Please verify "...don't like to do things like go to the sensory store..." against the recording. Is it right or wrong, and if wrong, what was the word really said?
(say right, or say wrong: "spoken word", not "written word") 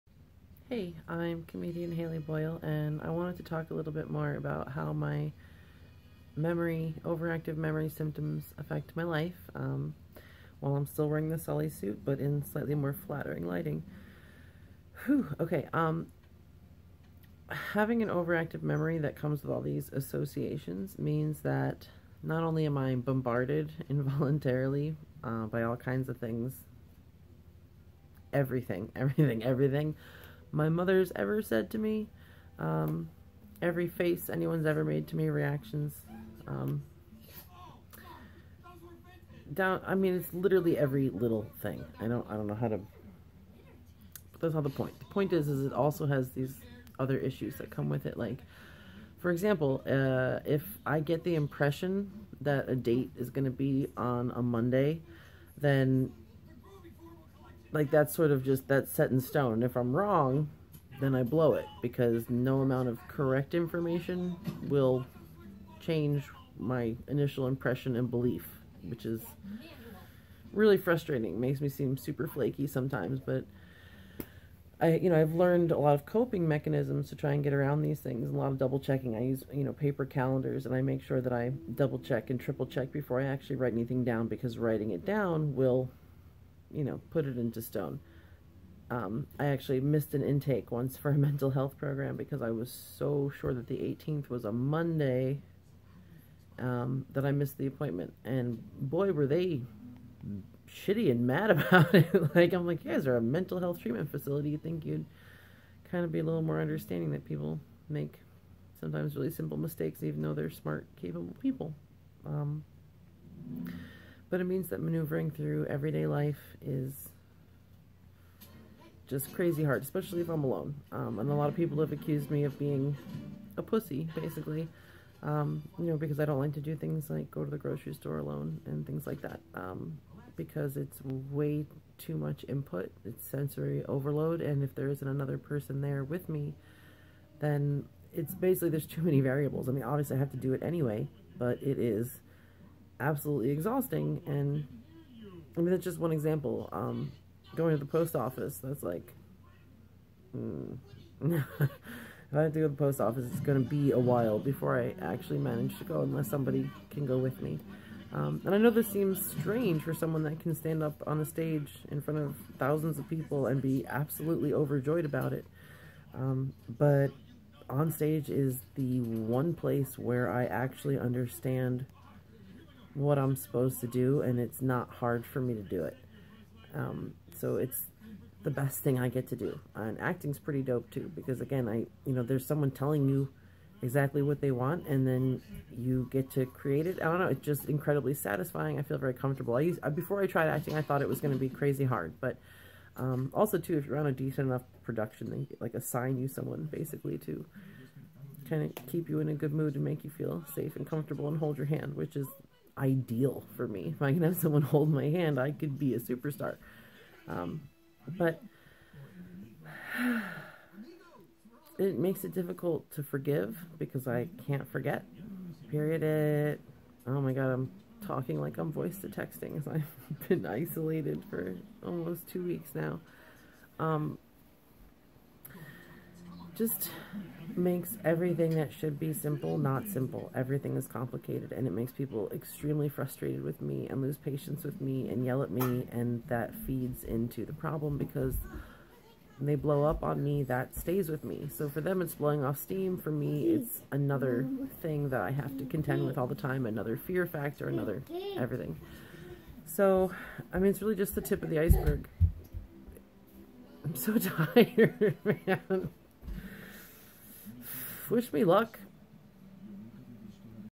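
wrong: "grocery", not "sensory".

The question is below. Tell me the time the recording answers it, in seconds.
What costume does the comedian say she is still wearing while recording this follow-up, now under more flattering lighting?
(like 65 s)
11 s.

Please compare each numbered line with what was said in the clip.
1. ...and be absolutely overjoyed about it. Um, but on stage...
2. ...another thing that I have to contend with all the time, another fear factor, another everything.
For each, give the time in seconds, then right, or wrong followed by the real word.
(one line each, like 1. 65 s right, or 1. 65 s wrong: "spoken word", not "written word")
1. 163 s right
2. 243 s right.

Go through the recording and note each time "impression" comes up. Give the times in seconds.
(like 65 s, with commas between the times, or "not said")
51 s, 67 s.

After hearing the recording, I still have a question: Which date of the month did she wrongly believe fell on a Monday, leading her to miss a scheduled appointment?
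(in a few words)
18th.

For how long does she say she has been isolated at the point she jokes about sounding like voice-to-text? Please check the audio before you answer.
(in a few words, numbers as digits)
2 weeks.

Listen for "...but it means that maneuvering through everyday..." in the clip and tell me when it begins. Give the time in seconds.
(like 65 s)
114 s.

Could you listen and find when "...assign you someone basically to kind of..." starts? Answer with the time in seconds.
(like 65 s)
195 s.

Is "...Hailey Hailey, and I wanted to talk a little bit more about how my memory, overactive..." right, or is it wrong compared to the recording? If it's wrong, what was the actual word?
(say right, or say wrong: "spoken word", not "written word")
wrong: "Boyle", not "Hailey".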